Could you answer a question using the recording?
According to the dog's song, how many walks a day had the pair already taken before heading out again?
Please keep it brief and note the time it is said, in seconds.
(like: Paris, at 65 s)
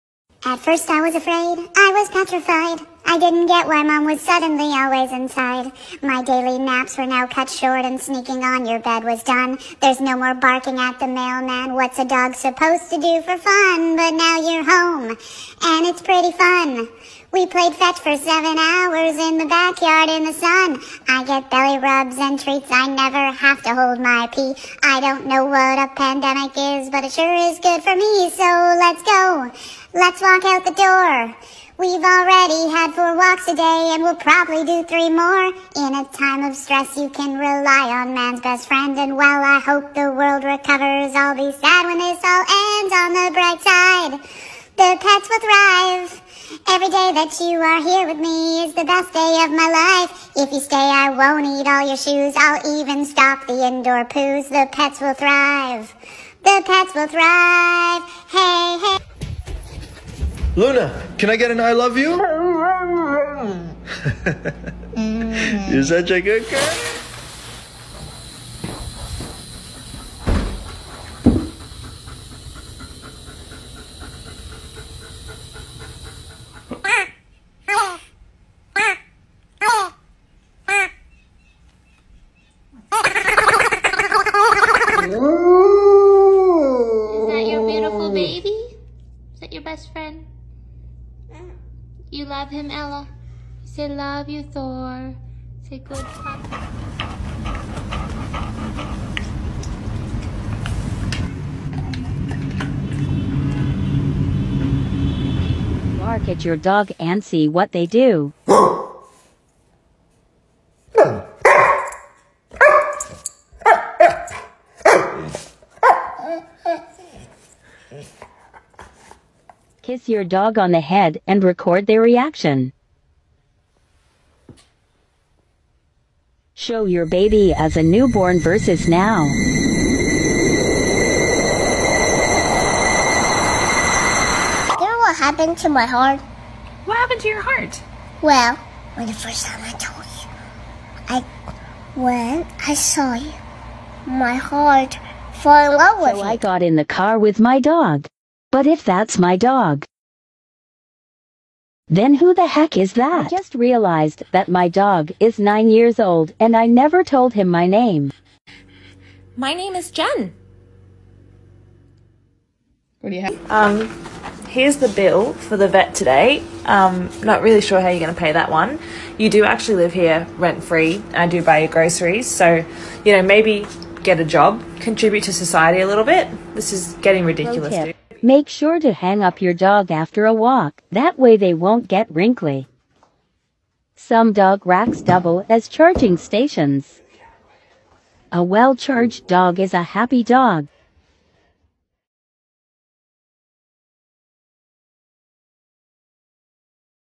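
4, at 32 s.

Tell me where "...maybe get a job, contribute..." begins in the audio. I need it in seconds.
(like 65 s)
173 s.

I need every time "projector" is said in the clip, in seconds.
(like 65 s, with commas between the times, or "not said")
not said.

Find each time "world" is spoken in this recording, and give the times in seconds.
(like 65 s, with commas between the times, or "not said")
40 s.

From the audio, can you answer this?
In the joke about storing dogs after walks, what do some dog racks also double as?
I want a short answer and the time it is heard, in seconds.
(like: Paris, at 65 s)
Charging stations, at 185 s.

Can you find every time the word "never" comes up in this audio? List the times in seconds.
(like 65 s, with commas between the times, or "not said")
22 s, 156 s.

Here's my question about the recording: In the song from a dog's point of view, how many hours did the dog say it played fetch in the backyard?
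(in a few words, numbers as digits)
7.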